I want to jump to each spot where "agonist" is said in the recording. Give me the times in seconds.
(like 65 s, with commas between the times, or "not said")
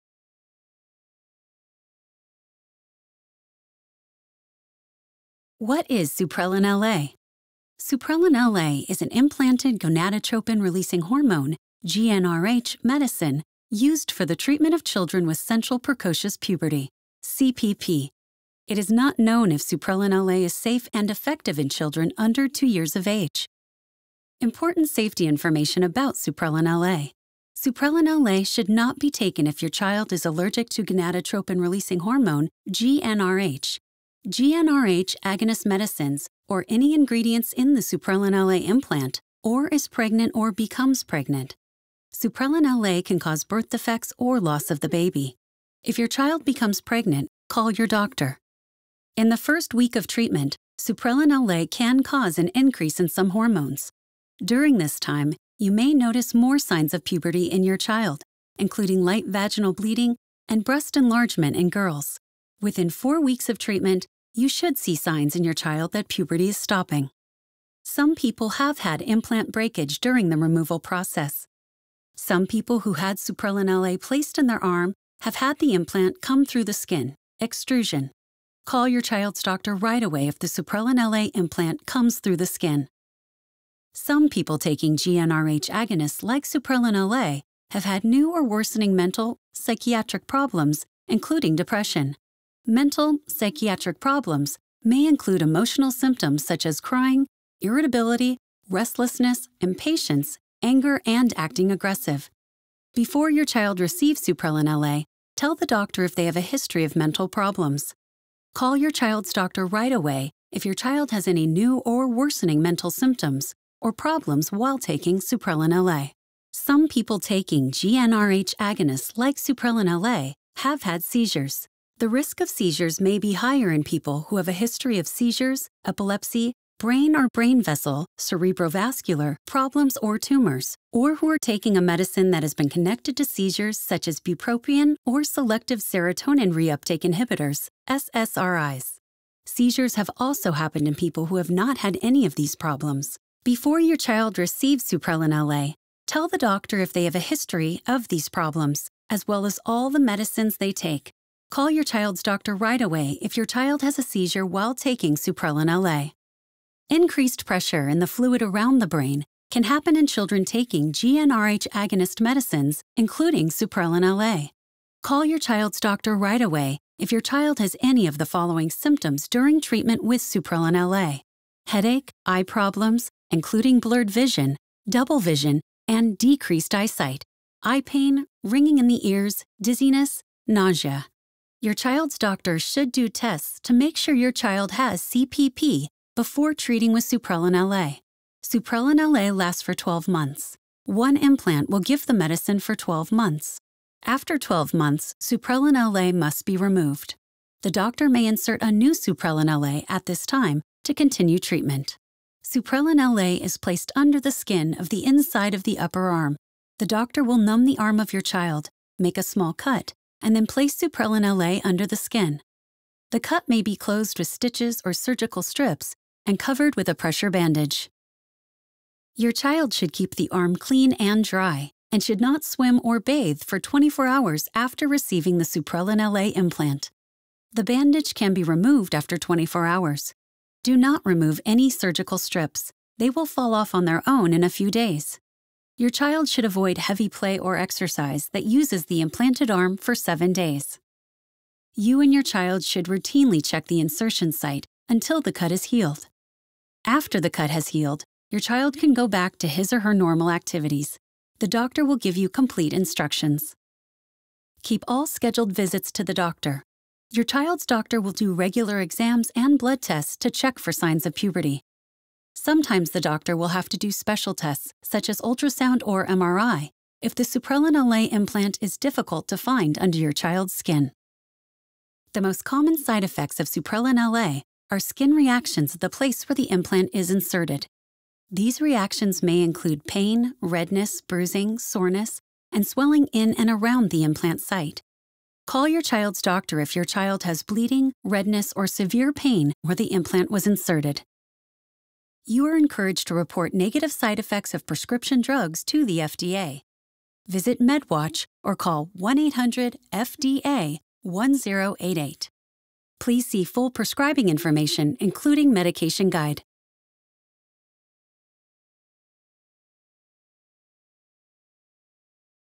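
35 s, 85 s, 118 s, 161 s.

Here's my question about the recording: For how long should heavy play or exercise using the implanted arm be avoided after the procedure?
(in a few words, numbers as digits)
7 days.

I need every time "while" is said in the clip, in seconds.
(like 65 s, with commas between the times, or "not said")
114 s, 154 s.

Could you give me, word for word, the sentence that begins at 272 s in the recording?
The most common side effects of Supprelin LA are skin reactions at the place where the implant is inserted.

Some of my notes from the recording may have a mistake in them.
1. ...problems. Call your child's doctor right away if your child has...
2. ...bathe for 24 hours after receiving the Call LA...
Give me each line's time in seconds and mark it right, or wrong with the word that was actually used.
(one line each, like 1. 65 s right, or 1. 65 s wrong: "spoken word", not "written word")
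1. 107 s right
2. 222 s wrong: "Supprelin", not "Call".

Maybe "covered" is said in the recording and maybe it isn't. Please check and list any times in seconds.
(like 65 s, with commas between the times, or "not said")
216 s.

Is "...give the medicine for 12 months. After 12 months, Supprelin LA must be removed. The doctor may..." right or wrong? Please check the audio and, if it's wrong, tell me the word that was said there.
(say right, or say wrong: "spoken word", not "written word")
right.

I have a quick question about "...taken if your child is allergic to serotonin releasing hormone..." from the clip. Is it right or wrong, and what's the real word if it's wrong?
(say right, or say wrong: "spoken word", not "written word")
wrong: "gonadotropin", not "serotonin".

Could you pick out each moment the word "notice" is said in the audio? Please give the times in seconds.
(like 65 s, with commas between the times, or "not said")
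55 s.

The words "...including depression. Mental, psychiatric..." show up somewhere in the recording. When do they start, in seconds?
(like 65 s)
91 s.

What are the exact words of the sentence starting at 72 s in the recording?
Some people who had Supprelin LA placed in their arm have had the implant come through the skin, extrusion.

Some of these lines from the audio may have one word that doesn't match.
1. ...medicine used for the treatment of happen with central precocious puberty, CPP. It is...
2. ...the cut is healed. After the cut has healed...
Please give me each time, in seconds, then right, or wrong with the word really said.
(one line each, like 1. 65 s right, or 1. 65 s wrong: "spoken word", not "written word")
1. 12 s wrong: "children", not "happen"
2. 245 s right.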